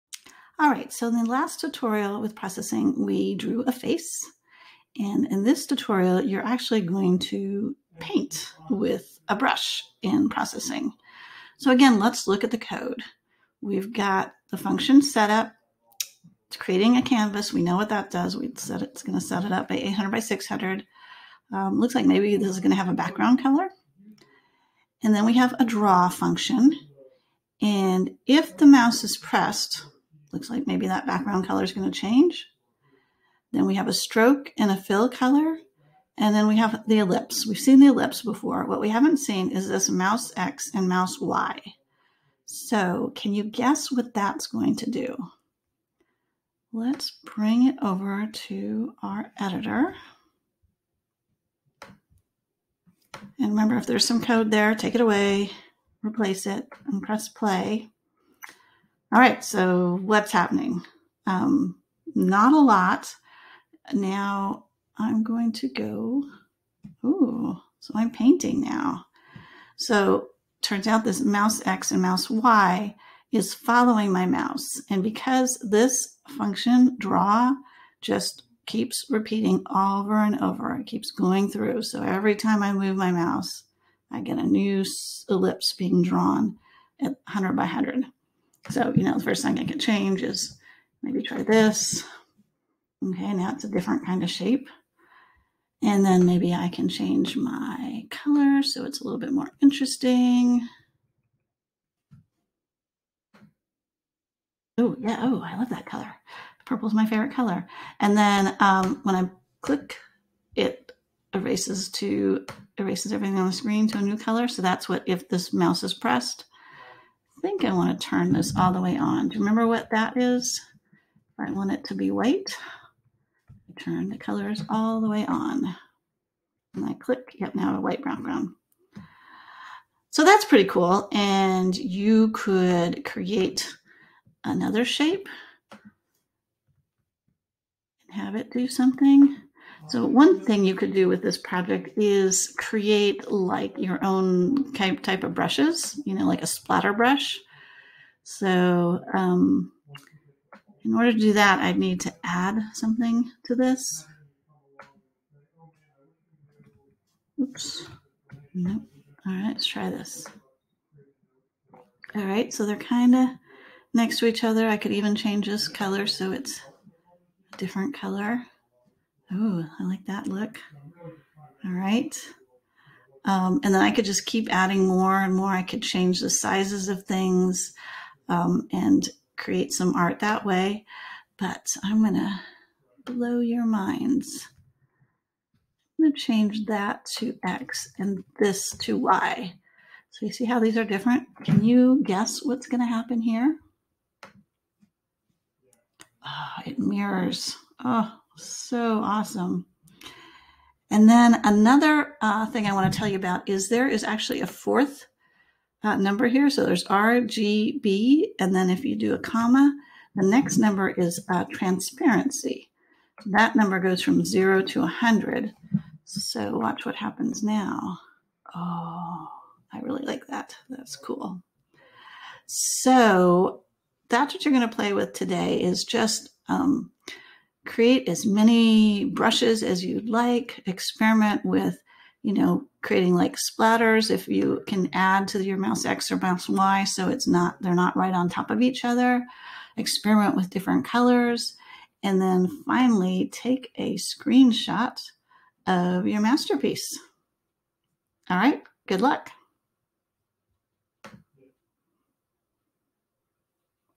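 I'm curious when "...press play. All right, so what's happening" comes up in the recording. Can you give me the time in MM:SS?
00:57.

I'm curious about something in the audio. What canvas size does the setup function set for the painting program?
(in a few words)
800 by 600.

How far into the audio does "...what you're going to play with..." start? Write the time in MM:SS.
03:44.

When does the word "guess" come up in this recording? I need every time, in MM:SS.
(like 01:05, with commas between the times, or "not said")
00:43, 03:12.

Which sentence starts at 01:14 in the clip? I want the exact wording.
And because this function draw just keeps repeating over and over, it keeps going through.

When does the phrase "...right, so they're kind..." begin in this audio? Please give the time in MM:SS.
02:42.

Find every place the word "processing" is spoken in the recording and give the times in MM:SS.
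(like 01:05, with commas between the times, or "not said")
00:02, 00:10.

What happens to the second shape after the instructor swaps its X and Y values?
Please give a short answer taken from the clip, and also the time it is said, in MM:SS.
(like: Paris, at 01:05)
It mirrors, at 03:16.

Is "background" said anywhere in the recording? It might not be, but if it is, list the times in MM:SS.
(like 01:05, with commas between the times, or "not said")
00:22, 00:31, 02:08.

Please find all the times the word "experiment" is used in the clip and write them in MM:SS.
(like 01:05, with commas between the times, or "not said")
03:50, 03:59.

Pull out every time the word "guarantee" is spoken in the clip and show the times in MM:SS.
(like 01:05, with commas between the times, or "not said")
not said.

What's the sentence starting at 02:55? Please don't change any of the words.
I could change the sizes of things um, and create some art that way.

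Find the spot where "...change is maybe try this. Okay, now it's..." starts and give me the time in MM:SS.
01:29.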